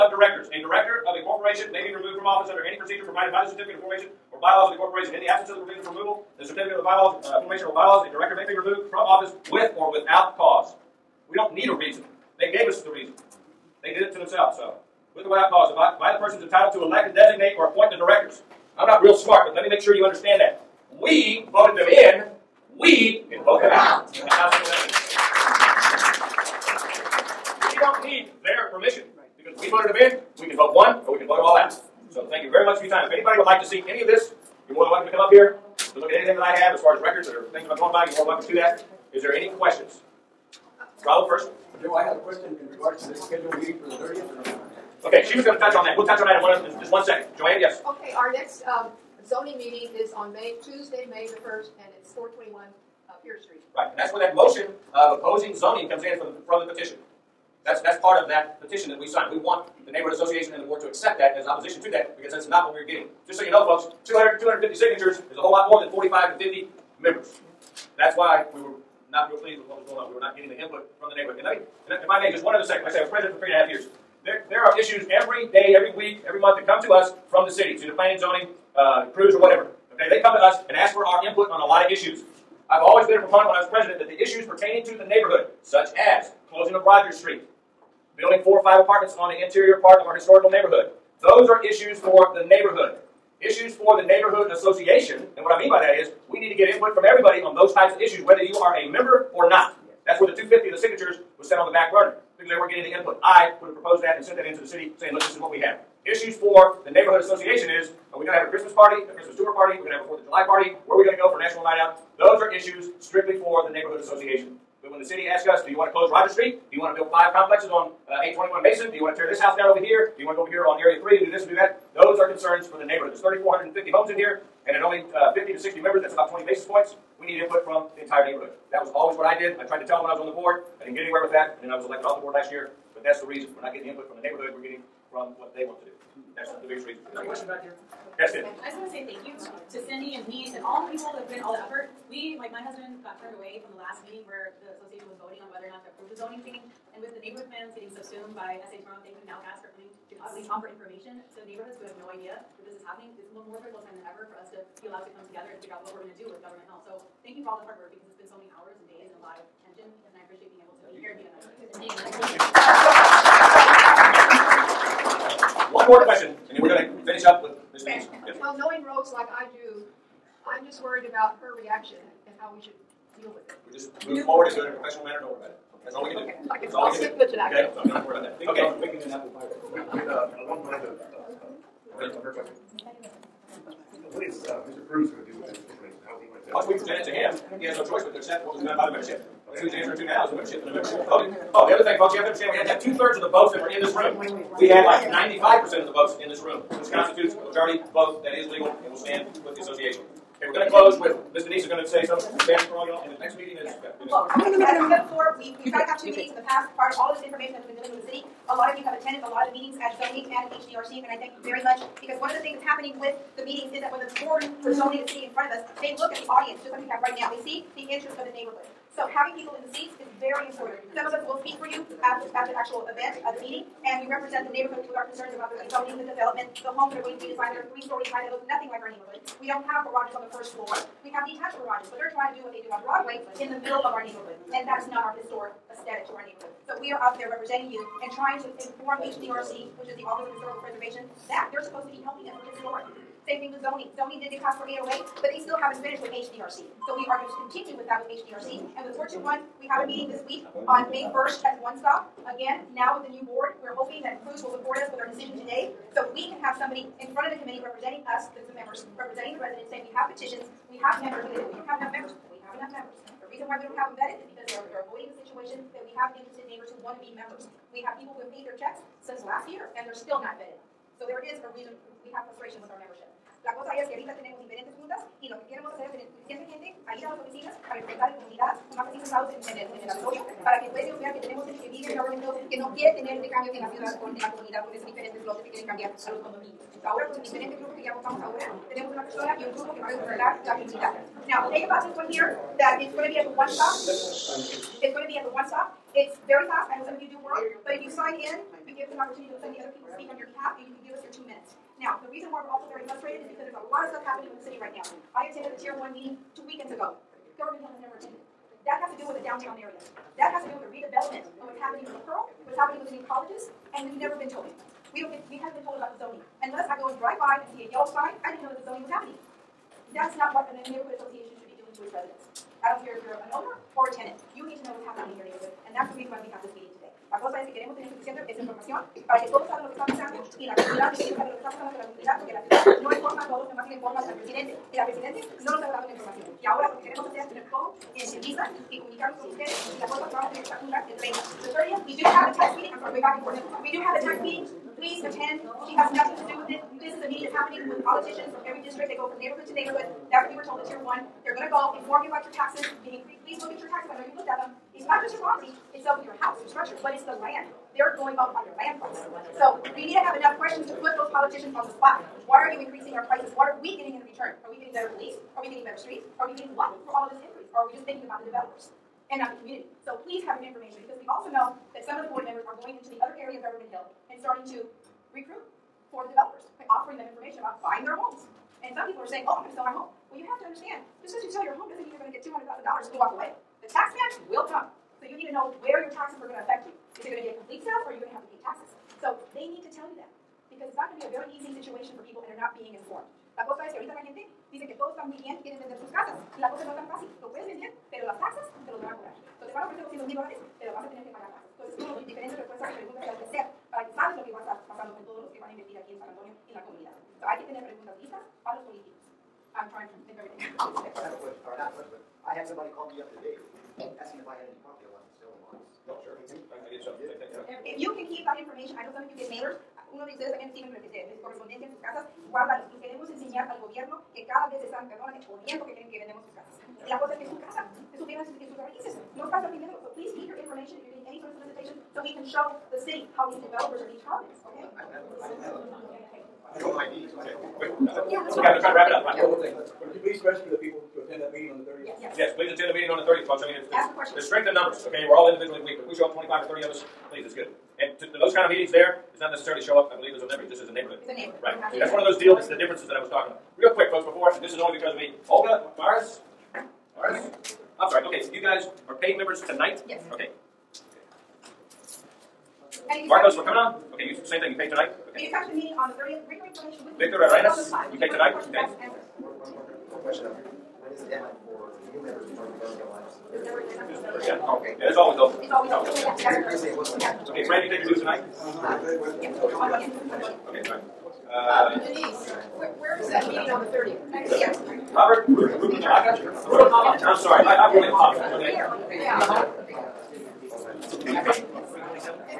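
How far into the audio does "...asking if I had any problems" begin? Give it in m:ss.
6:54.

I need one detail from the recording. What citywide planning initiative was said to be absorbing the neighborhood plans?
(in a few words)
SA Tomorrow.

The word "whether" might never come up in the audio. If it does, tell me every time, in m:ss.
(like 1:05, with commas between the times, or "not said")
1:38, 2:25.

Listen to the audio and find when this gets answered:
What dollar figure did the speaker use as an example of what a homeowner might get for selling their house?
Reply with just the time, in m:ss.
6:22.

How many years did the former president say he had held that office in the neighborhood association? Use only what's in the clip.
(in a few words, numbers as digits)
3 and a half years.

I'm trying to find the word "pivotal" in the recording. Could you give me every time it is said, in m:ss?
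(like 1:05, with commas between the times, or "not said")
not said.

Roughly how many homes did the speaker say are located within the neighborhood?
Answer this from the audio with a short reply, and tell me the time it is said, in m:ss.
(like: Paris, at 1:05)
3,450, at 2:03.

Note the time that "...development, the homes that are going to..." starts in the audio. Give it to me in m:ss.
3:46.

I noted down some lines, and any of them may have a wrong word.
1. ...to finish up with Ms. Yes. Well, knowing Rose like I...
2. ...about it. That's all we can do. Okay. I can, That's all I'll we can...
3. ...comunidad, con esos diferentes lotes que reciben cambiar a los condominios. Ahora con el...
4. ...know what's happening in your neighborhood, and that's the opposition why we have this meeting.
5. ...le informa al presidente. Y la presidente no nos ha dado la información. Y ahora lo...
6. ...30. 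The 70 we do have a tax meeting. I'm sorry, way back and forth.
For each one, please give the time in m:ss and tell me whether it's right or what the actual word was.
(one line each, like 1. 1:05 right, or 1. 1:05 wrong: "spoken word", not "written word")
1. 2:46 right
2. 2:55 right
3. 4:44 wrong: "quieren", not "reciben"
4. 5:24 wrong: "reason", not "opposition"
5. 5:33 right
6. 5:41 wrong: "30", not "70".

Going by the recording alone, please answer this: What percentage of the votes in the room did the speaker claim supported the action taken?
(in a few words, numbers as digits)
95%.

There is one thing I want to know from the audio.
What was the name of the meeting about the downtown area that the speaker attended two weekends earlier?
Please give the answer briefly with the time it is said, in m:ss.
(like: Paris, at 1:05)
Tier 1, at 5:05.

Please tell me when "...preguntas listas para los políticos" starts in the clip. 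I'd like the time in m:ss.
6:47.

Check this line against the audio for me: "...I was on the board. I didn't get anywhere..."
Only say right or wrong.
right.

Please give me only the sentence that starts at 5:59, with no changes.
So we need to have enough questions to put those politicians on the spot.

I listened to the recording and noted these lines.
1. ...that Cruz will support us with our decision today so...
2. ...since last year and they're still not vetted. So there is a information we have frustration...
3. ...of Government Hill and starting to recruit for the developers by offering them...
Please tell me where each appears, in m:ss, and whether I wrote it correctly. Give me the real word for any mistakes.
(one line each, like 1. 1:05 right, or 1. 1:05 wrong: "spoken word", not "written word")
1. 4:14 right
2. 4:29 wrong: "reason", not "information"
3. 6:13 right.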